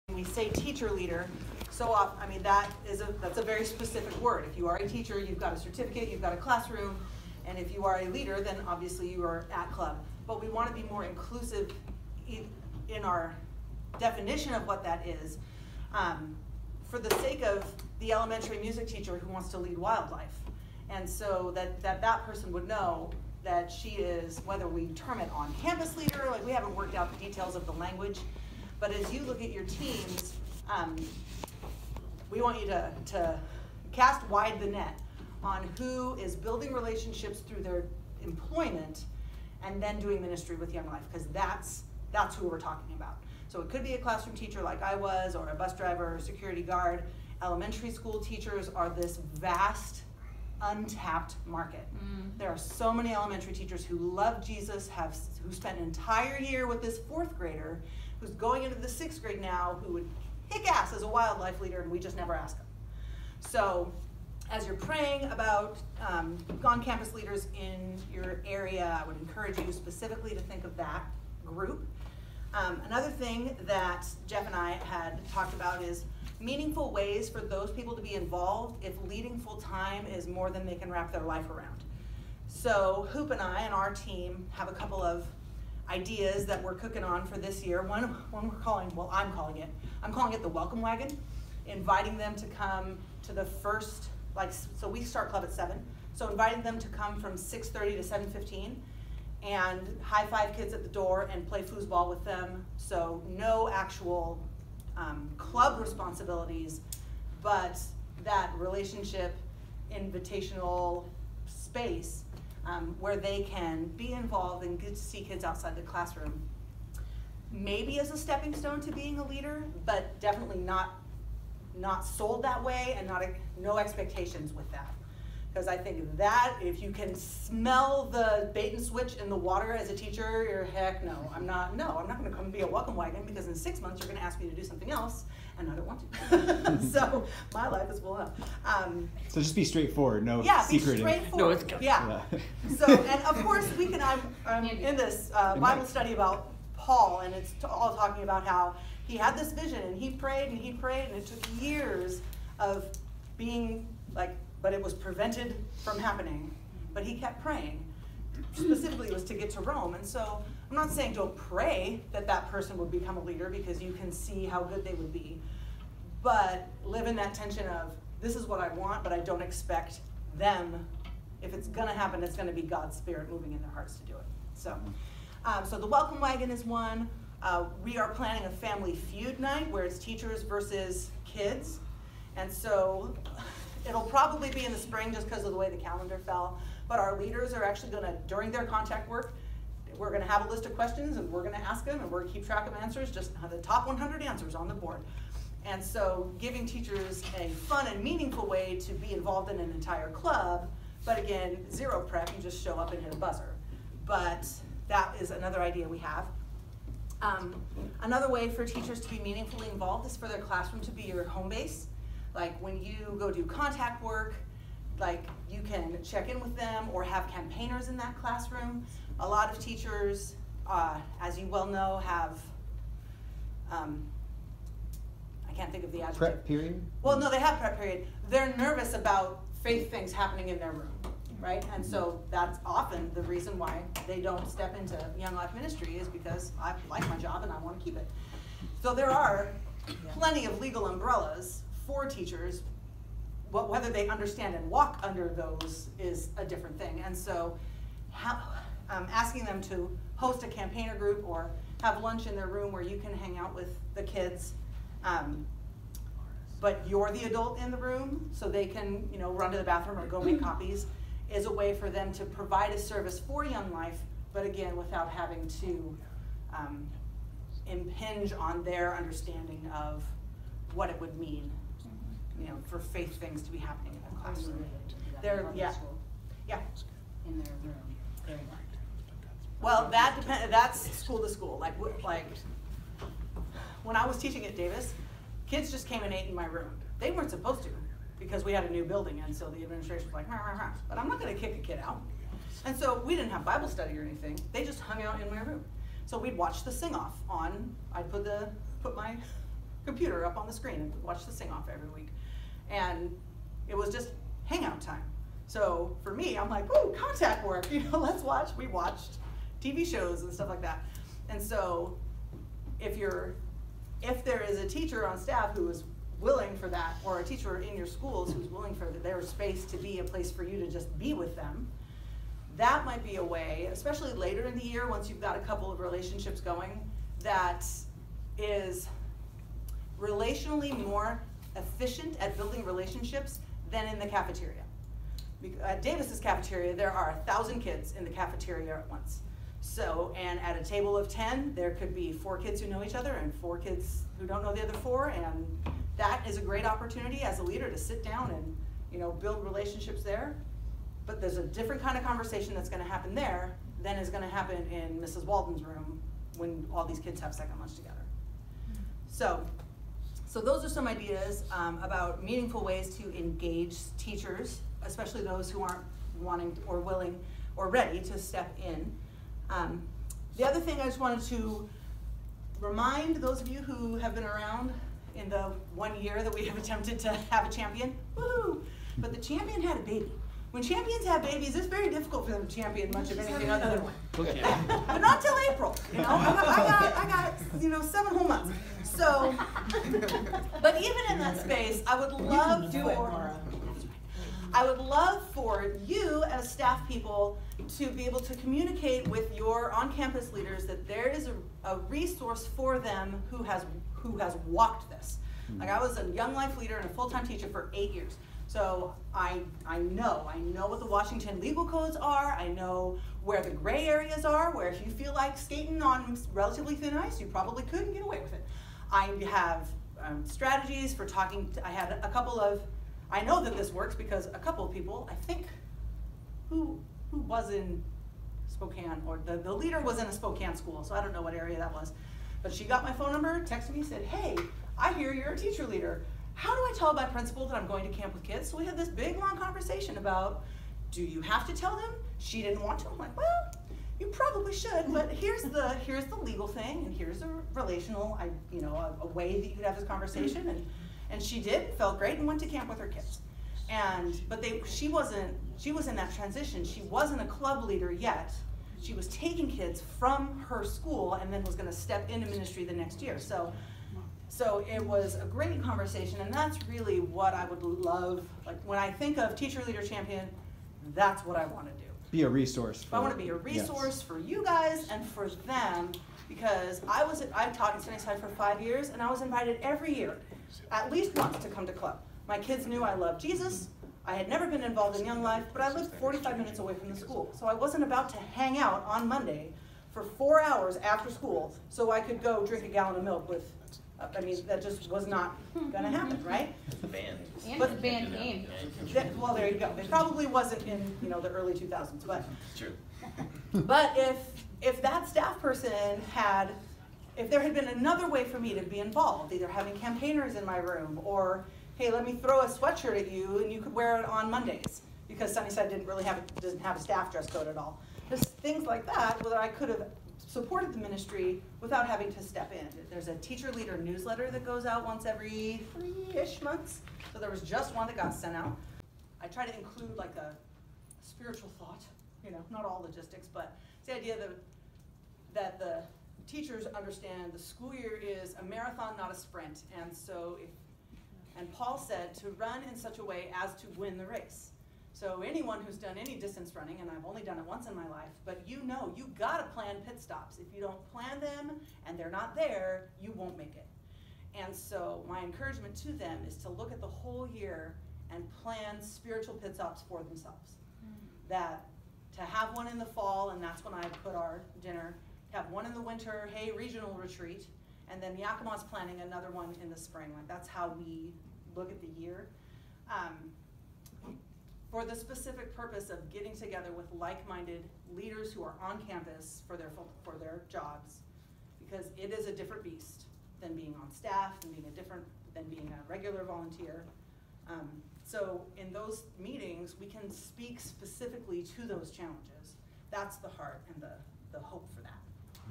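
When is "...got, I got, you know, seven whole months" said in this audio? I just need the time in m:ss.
6:26.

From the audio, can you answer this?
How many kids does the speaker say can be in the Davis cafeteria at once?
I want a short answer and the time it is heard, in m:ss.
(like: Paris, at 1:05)
1,000, at 5:37.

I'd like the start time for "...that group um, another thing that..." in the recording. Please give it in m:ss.
1:10.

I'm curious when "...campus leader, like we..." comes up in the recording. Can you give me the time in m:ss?
0:25.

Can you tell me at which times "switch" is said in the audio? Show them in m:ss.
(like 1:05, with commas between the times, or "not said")
2:08.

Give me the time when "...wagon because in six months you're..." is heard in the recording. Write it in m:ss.
2:12.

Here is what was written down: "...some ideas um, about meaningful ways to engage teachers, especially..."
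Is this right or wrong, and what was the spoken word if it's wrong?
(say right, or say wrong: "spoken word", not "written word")
right.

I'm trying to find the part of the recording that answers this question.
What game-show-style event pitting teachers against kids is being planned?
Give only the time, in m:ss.
2:58.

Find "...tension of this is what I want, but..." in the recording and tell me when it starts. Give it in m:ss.
2:47.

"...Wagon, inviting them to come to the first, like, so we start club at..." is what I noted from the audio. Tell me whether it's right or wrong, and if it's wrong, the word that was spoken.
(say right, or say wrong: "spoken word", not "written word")
right.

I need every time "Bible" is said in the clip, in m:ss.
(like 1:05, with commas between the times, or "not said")
2:25, 4:53.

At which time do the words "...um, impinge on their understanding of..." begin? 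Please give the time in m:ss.
4:26.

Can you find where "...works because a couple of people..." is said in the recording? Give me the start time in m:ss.
7:03.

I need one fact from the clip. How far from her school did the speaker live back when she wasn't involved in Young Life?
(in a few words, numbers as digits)
45 minutes.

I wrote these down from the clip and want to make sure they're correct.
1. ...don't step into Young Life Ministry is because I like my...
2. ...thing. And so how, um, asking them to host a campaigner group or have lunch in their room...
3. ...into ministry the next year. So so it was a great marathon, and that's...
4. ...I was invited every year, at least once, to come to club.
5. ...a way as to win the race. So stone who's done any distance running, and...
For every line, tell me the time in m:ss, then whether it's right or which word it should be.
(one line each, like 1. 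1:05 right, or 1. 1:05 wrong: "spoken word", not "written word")
1. 3:54 right
2. 4:06 right
3. 7:42 wrong: "conversation", not "marathon"
4. 7:59 right
5. 9:02 wrong: "anyone", not "stone".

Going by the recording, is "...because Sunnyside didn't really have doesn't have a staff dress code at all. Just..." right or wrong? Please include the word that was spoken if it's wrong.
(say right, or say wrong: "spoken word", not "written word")
right.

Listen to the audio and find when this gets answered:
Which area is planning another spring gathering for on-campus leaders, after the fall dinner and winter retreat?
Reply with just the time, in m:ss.
9:28.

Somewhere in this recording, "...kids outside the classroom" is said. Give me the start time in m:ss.
1:55.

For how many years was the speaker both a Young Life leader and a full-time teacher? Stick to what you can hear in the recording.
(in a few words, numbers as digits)
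8.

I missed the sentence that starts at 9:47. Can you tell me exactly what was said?
Um, so in those meetings, we can speak specifically to those challenges.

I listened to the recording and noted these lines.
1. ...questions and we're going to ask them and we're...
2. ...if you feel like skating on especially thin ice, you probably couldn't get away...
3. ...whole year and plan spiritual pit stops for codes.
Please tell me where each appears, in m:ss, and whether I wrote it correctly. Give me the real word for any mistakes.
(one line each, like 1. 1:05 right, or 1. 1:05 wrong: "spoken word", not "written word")
1. 3:10 right
2. 6:54 wrong: "relatively", not "especially"
3. 9:16 wrong: "themselves", not "codes".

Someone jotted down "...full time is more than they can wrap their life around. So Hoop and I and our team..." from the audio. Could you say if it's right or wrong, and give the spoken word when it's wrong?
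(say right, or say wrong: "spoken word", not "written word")
right.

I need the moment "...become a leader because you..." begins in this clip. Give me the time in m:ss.
2:42.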